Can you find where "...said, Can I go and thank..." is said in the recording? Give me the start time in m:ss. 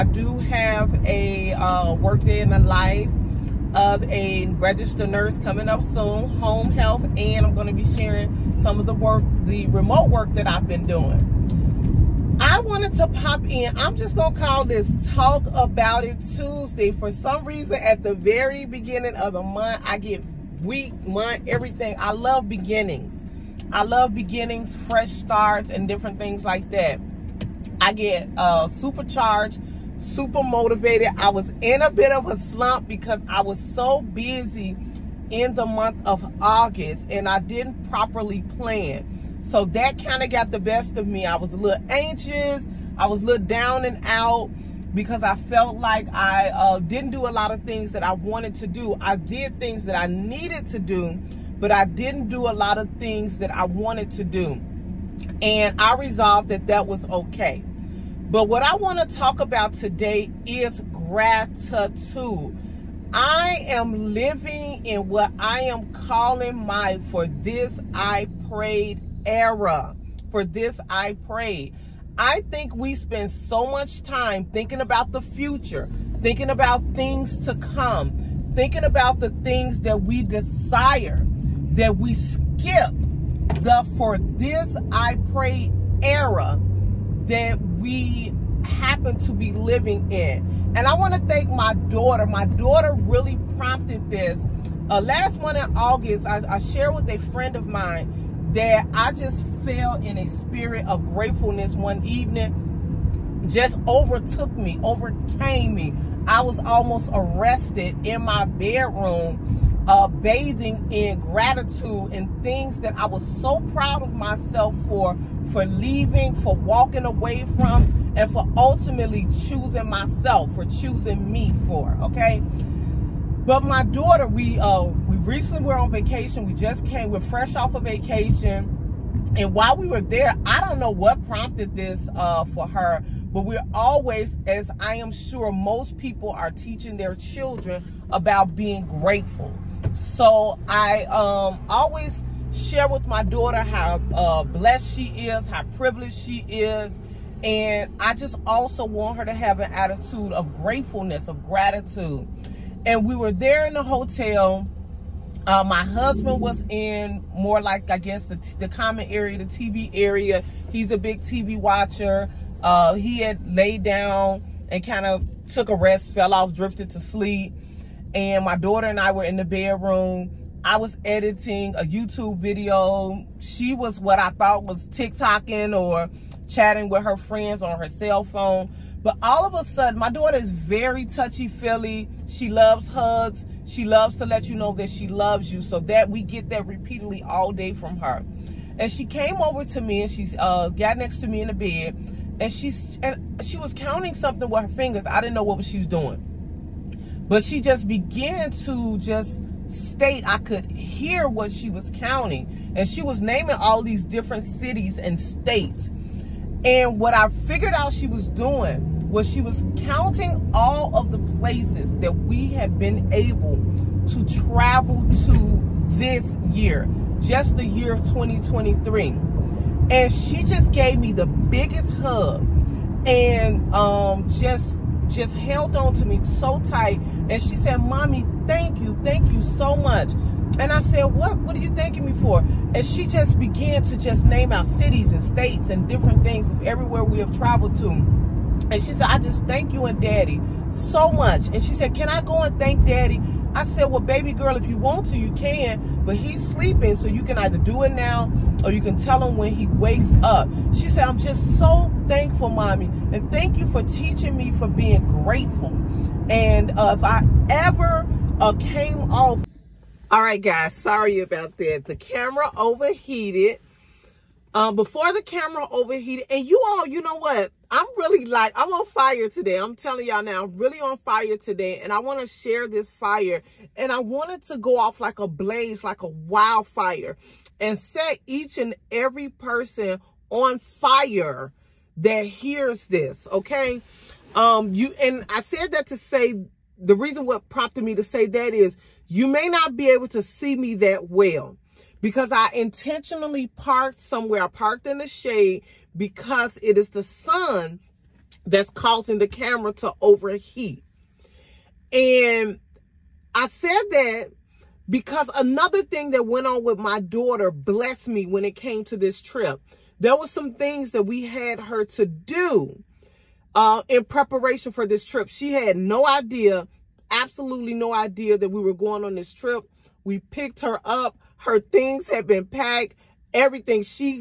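4:01.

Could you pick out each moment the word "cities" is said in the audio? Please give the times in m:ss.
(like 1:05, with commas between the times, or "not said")
3:24, 3:54.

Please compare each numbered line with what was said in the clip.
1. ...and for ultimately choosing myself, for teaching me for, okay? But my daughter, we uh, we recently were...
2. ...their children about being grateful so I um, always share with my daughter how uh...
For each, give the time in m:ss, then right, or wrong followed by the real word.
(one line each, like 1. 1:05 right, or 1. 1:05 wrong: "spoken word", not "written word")
1. 1:58 wrong: "choosing", not "teaching"
2. 2:16 right.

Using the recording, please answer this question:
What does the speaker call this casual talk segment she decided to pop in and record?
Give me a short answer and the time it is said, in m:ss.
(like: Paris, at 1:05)
Talk About It Tuesday, at 0:15.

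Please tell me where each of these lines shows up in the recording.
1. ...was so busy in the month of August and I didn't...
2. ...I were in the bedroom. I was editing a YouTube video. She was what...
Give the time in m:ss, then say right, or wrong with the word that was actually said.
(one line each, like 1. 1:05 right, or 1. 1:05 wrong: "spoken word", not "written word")
1. 0:33 right
2. 2:48 right.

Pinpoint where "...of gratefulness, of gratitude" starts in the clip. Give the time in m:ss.
2:30.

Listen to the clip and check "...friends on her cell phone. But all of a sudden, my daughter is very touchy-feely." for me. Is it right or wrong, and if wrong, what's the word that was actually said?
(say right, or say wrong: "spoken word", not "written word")
right.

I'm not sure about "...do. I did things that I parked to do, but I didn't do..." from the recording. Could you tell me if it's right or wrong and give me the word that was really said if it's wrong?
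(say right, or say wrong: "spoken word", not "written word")
wrong: "needed", not "parked".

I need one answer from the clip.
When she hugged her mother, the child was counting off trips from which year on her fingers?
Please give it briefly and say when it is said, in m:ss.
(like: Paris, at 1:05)
2023, at 3:38.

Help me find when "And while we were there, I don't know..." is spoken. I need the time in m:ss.
2:09.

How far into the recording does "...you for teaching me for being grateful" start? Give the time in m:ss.
4:13.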